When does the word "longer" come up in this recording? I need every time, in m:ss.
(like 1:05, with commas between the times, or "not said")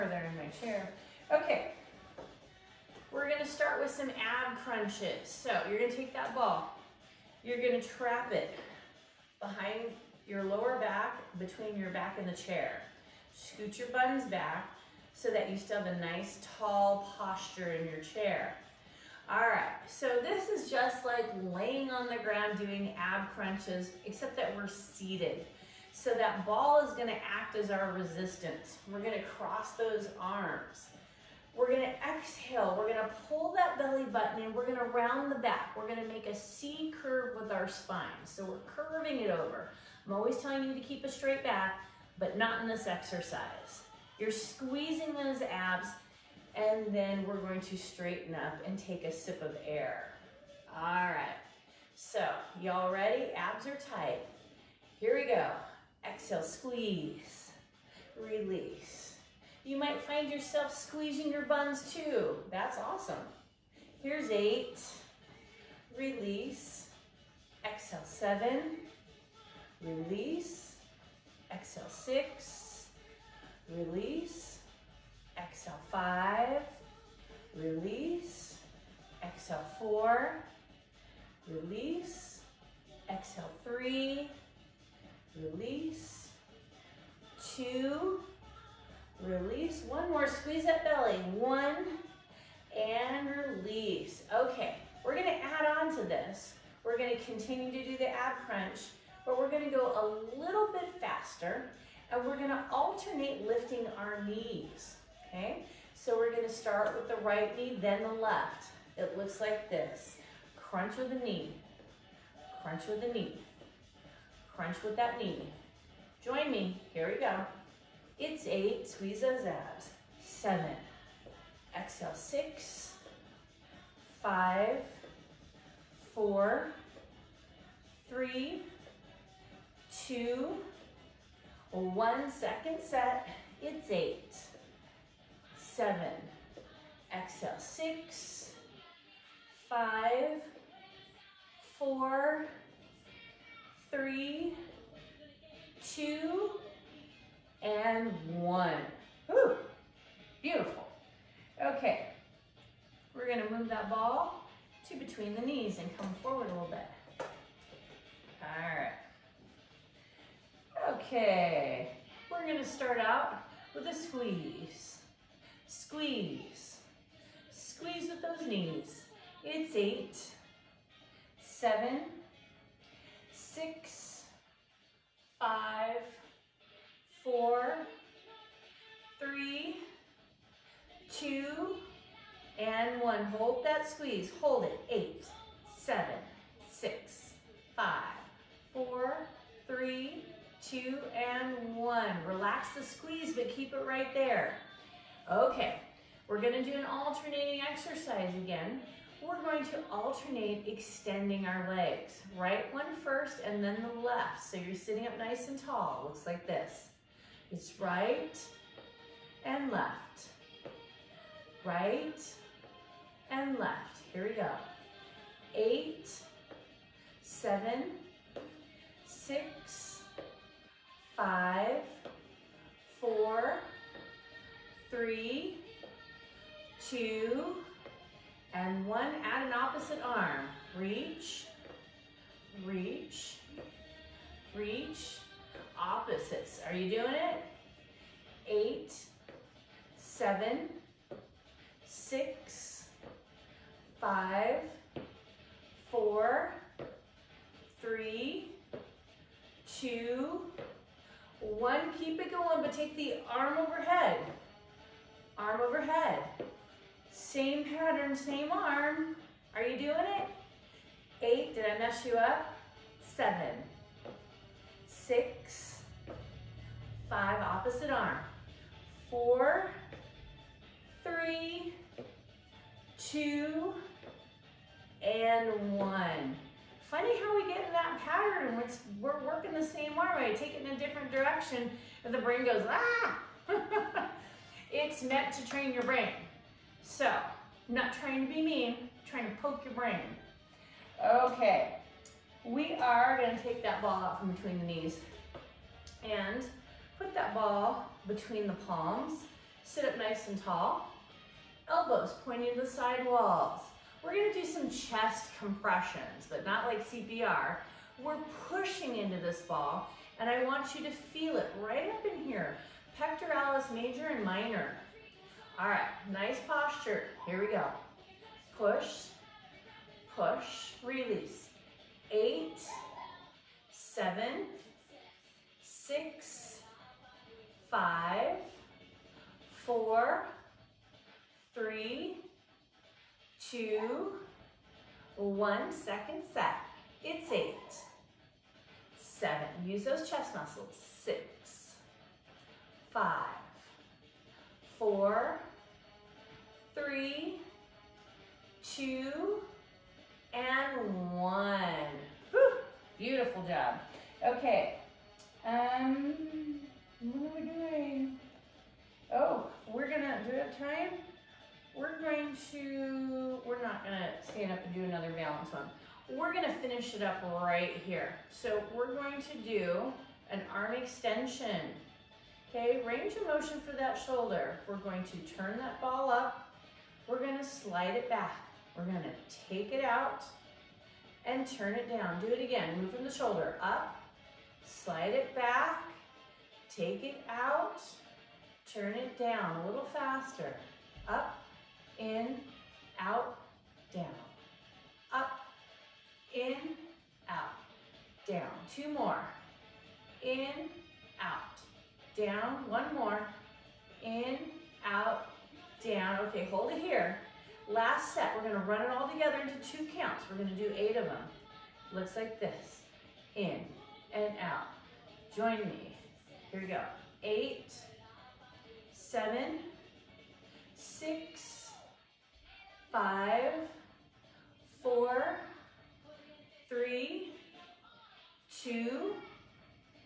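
not said.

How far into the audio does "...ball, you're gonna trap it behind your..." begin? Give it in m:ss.
0:06.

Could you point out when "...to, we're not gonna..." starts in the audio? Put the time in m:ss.
6:02.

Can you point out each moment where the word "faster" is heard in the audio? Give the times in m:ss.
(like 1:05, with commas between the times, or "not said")
1:41, 6:29.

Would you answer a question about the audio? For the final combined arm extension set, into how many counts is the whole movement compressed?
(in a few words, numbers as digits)
2.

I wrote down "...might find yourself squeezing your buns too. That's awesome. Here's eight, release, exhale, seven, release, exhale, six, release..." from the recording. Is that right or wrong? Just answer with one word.
right.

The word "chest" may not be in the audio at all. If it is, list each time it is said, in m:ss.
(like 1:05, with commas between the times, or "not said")
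5:04, 5:40.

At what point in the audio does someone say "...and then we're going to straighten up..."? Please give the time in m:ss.
0:46.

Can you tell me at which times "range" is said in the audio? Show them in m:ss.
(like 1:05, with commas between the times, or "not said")
6:12.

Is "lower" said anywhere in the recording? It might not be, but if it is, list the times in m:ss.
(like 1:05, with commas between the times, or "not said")
0:10.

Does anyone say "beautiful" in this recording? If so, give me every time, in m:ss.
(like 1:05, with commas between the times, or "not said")
2:30, 5:52.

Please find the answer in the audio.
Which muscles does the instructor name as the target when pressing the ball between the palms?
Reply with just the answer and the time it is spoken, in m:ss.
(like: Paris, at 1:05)
Pectoralis major and minor, at 5:12.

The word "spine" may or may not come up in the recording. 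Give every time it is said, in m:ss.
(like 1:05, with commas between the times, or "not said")
0:37.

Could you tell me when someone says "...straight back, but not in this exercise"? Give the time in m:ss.
0:41.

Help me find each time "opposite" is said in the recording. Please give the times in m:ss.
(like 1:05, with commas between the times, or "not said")
3:49, 3:55, 4:27.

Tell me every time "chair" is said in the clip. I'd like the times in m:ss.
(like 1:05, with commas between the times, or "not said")
0:00, 0:12, 0:18.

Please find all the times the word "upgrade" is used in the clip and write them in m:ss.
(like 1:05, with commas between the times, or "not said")
not said.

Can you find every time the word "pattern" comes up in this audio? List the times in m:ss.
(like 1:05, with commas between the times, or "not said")
4:17, 4:37.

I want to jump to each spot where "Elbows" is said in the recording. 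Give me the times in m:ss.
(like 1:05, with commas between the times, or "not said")
5:01.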